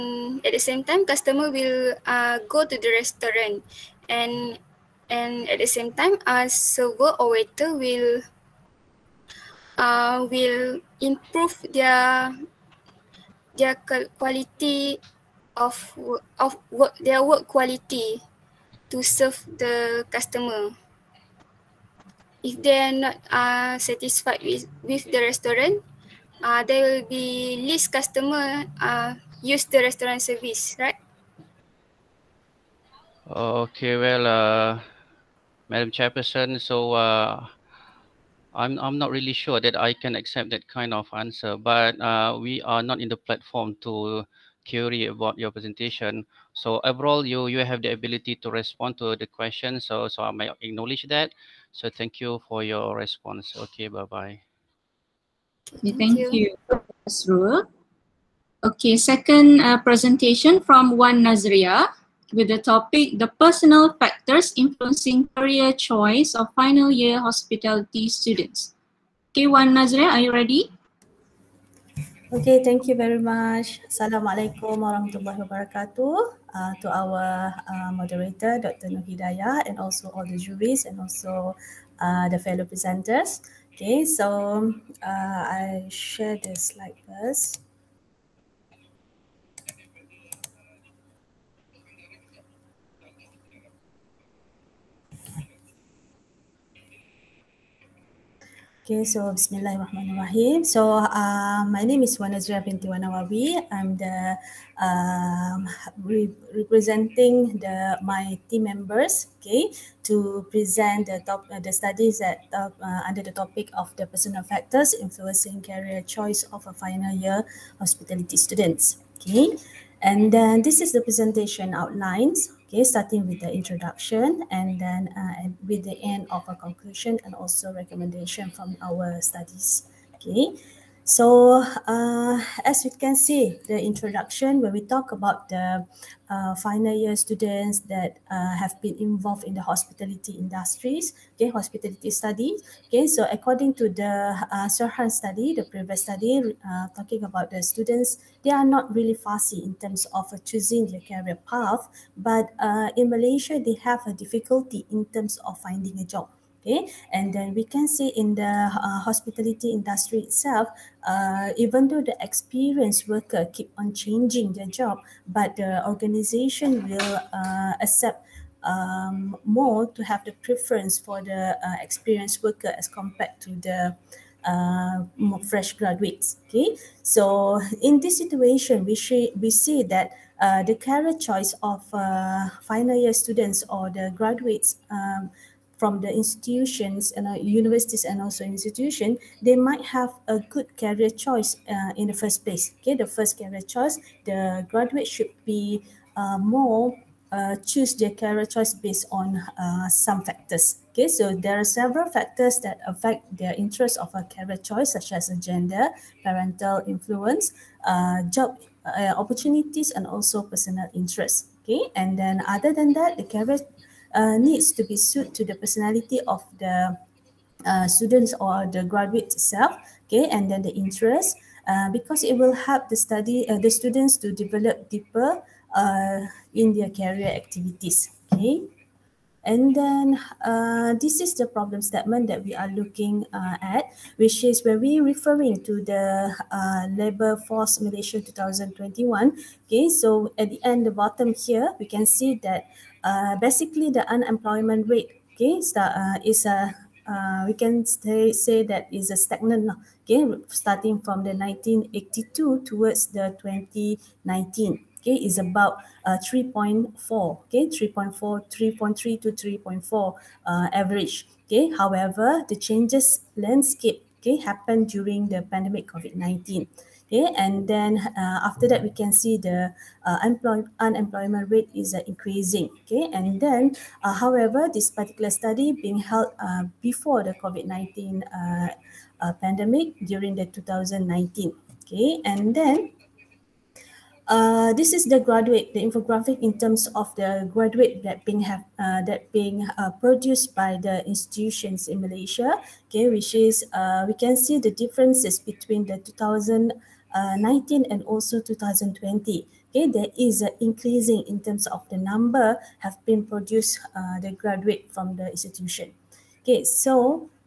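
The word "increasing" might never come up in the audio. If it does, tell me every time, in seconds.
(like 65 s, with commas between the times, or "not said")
272 s, 300 s.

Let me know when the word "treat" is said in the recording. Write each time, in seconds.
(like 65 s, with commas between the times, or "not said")
not said.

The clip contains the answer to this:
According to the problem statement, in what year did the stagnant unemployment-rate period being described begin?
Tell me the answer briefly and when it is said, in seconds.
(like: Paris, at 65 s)
1982, at 251 s.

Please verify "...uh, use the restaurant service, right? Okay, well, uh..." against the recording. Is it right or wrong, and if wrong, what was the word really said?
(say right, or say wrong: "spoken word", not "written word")
right.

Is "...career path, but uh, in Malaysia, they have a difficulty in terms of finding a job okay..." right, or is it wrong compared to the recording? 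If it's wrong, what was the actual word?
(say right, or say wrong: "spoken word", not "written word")
right.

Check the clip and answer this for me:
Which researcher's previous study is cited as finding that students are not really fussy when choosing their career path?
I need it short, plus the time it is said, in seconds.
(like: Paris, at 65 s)
Sirhan, at 144 s.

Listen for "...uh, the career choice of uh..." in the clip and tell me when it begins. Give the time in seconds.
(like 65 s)
180 s.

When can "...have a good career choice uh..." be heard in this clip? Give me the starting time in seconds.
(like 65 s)
189 s.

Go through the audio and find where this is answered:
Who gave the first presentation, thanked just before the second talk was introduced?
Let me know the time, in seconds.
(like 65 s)
57 s.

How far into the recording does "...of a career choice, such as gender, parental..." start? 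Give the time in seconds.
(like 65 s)
203 s.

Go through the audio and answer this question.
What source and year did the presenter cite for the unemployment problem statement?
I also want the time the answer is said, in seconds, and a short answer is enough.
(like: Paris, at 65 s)
Labor force Malaysia 2021, at 236 s.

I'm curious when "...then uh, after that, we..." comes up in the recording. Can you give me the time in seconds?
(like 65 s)
267 s.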